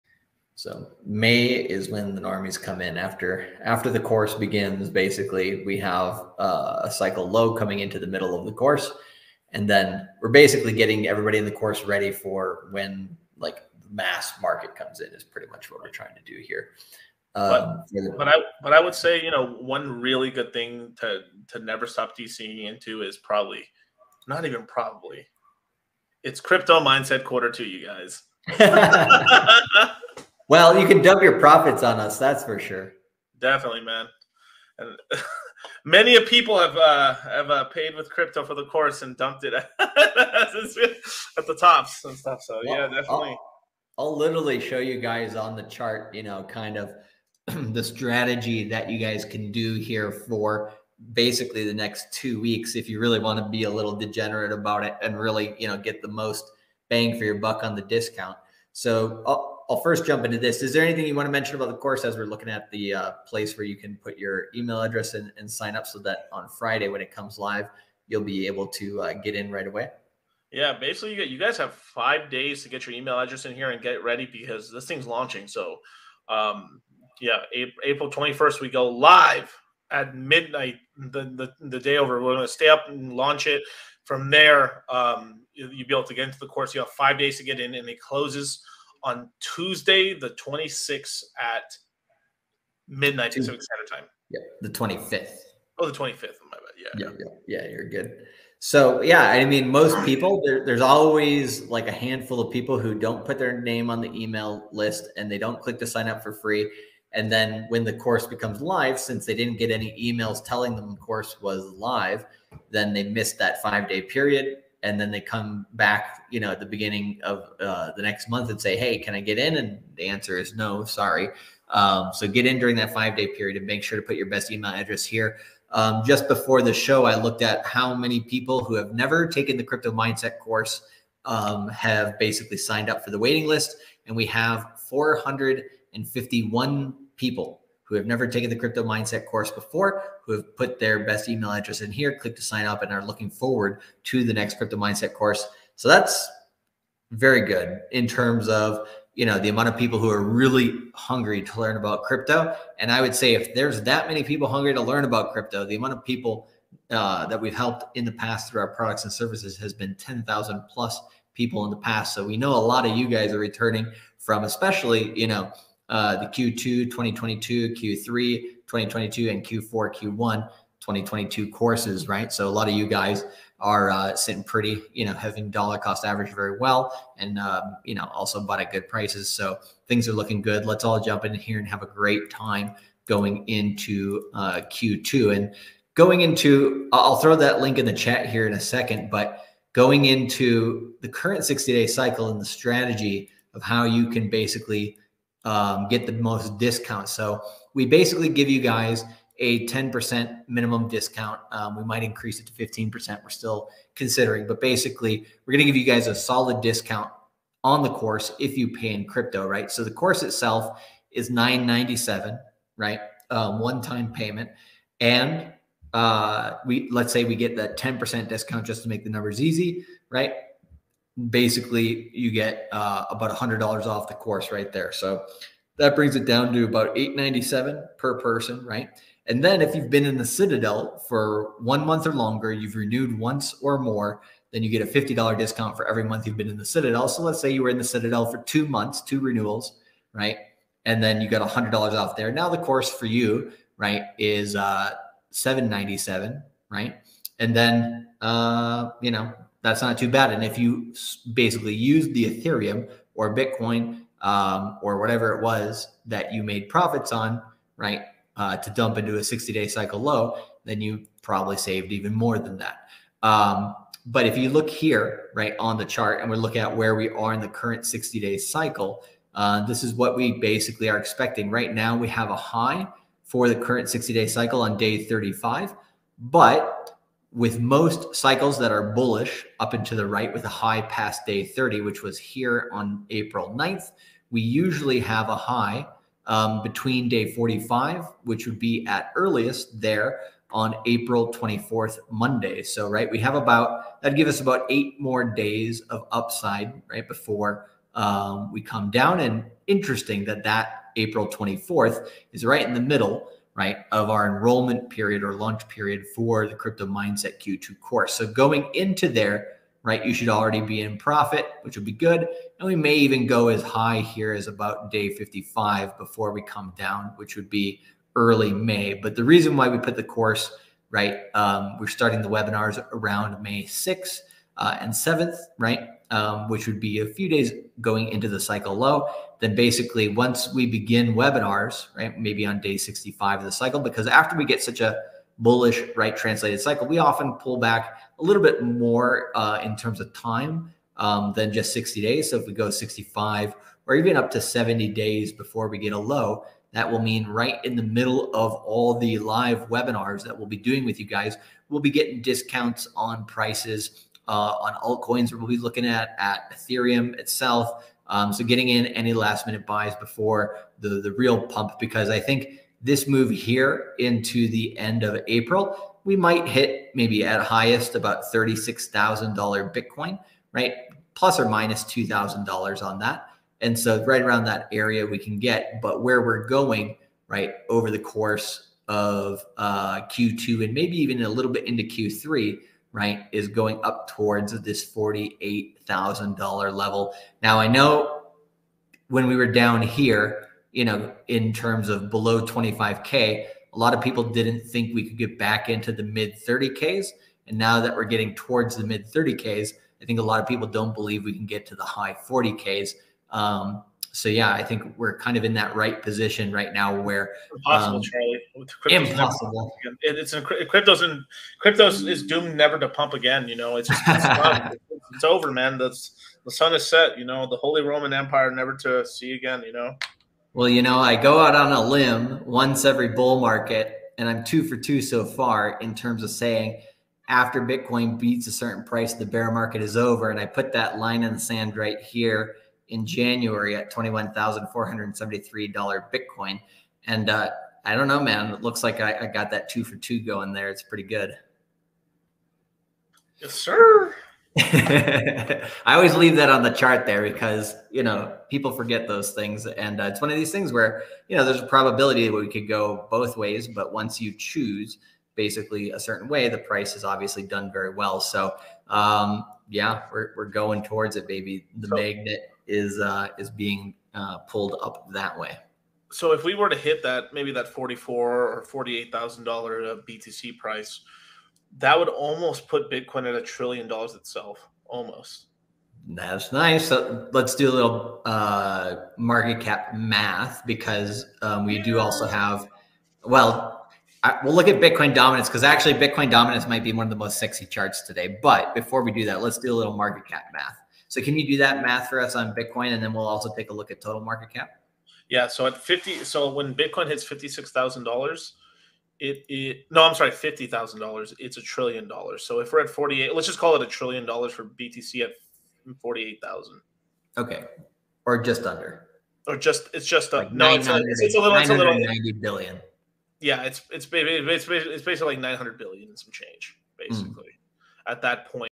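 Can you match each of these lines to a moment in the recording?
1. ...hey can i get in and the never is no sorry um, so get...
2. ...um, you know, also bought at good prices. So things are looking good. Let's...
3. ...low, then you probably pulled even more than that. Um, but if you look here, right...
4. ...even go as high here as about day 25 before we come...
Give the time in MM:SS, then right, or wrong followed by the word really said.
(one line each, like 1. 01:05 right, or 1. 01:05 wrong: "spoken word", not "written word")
1. 01:58 wrong: "answer", not "never"
2. 02:57 right
3. 04:19 wrong: "saved", not "pulled"
4. 05:12 wrong: "55", not "25".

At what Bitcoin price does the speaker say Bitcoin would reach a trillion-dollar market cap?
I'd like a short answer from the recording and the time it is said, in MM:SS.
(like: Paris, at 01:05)
$50,000, at 08:20.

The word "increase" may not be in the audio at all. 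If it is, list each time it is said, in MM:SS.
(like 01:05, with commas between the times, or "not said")
03:22.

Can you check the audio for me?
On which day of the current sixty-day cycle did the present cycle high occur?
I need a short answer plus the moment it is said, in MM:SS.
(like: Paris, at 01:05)
Day 35, at 04:34.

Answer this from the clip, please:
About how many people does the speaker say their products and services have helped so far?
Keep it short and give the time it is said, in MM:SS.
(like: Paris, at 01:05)
10,000 plus, at 02:39.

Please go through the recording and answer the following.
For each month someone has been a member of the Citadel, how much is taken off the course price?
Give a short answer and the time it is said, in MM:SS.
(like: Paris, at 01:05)
$50, at 03:54.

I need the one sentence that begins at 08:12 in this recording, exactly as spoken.
And then we'll also take a look at total market cap.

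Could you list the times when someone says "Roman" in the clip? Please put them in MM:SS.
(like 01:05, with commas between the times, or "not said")
06:57.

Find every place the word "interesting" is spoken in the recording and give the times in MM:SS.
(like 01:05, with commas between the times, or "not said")
04:59.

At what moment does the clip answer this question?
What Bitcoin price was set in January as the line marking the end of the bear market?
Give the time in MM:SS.
07:13.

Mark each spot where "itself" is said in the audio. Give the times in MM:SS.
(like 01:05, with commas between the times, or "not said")
03:30, 05:57, 07:54.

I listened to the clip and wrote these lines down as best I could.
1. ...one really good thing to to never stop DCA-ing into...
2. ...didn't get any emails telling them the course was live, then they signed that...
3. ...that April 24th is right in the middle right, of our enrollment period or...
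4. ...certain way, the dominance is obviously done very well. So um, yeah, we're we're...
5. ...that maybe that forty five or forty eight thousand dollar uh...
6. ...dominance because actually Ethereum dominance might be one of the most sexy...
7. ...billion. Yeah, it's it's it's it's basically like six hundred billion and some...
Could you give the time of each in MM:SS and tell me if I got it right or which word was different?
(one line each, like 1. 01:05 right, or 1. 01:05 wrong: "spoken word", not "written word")
1. 00:19 right
2. 01:49 wrong: "missed", not "signed"
3. 05:00 right
4. 07:35 wrong: "price", not "dominance"
5. 07:47 wrong: "four", not "five"
6. 08:05 wrong: "Bitcoin", not "Ethereum"
7. 08:32 wrong: "nine", not "six".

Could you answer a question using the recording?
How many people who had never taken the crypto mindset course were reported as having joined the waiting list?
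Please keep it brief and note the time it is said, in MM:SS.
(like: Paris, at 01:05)
451, at 02:14.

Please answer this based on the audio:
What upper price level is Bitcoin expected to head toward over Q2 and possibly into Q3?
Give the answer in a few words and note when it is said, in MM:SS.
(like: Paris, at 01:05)
$48,000, at 06:24.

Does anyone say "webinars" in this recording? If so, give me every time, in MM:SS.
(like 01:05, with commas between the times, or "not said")
05:22, 05:31, 05:49.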